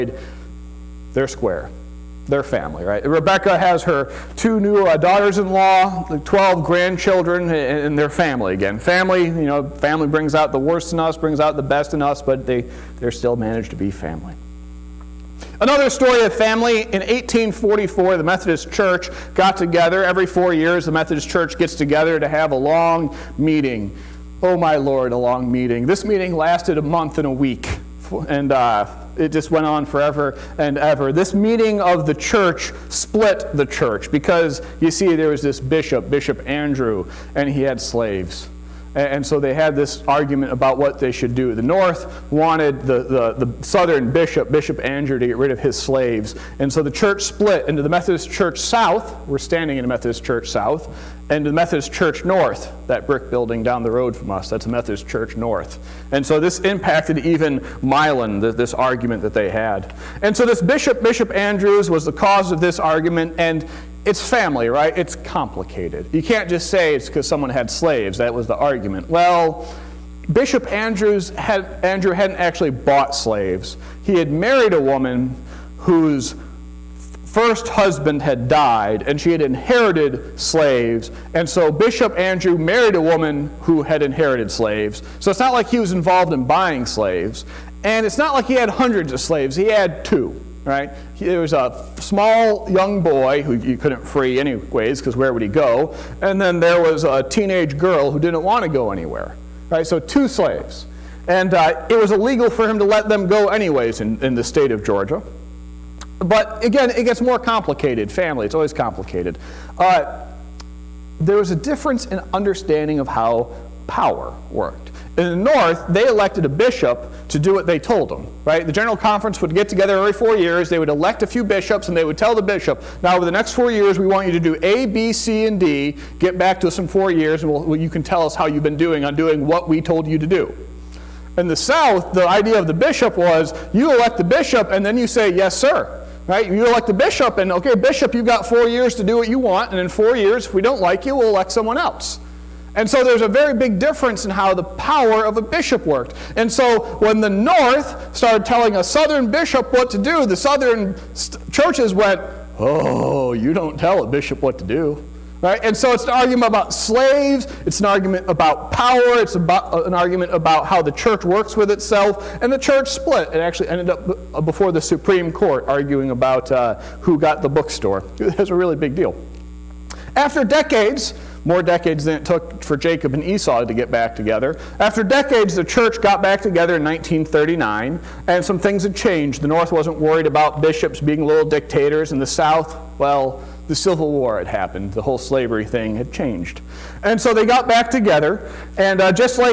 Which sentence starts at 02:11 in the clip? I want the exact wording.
In the South, the idea of the bishop was, you elect the bishop, and then you say, yes, sir.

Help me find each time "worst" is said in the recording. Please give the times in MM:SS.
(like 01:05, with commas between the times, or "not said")
00:10.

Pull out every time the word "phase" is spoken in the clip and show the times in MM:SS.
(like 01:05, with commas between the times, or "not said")
not said.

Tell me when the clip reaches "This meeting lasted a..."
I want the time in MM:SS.
00:25.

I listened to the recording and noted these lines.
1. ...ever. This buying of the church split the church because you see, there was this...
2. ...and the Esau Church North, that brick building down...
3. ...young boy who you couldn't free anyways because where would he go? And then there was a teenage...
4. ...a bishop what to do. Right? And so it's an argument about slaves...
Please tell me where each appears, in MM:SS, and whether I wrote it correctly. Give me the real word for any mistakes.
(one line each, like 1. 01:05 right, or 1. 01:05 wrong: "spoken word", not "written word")
1. 00:30 wrong: "meeting", not "buying"
2. 00:51 wrong: "Methodist", not "Esau"
3. 01:32 right
4. 02:34 right.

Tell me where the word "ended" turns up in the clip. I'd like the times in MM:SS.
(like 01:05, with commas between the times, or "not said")
02:43.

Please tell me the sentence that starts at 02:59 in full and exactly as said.
The North wasn't worried about bishops being little dictators, and the South, well, the Civil War had happened.